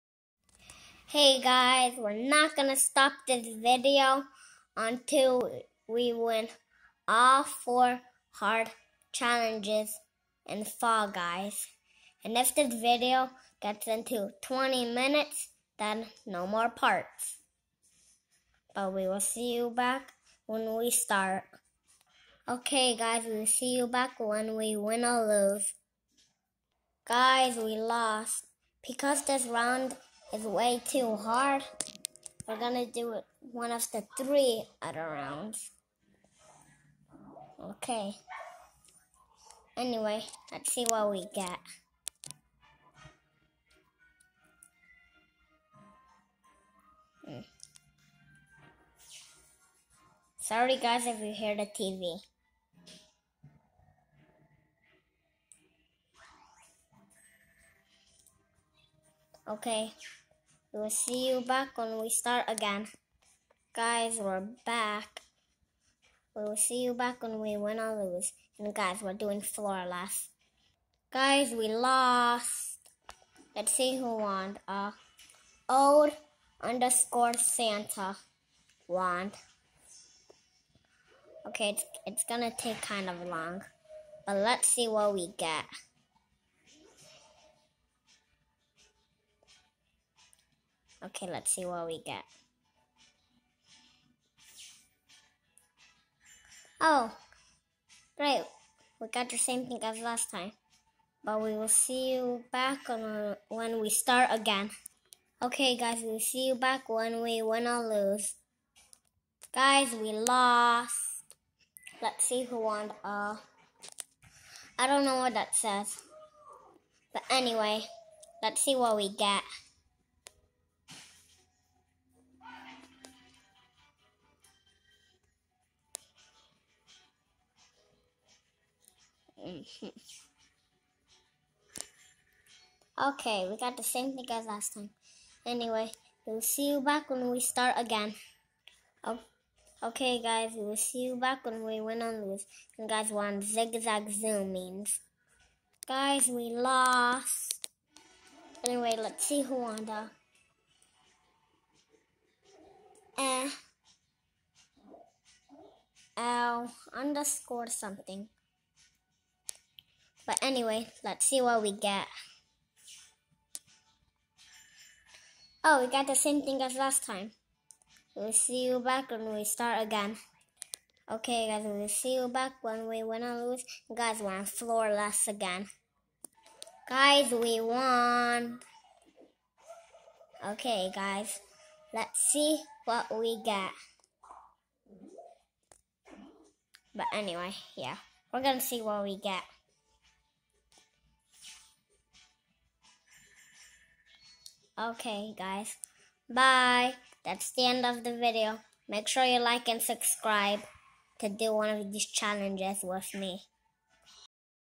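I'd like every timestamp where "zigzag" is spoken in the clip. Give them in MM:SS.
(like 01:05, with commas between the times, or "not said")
02:23.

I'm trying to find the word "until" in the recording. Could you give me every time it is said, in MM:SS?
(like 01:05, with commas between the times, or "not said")
00:04.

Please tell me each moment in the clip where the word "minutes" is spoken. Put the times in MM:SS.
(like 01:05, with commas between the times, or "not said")
00:14.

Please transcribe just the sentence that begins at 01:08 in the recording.
And guys, we're doing floor last.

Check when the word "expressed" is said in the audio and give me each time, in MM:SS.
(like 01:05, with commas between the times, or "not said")
not said.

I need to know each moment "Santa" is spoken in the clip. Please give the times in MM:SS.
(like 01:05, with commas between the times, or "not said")
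01:17.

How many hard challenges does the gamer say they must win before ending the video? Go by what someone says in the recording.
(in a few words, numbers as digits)
4.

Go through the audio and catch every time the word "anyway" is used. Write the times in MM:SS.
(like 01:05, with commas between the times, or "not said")
00:39, 01:57, 02:15, 02:28, 02:40, 03:07.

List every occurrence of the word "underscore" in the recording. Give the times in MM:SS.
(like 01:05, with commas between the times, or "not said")
01:16, 02:36.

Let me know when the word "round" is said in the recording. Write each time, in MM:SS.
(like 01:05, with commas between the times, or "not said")
00:29, 00:35.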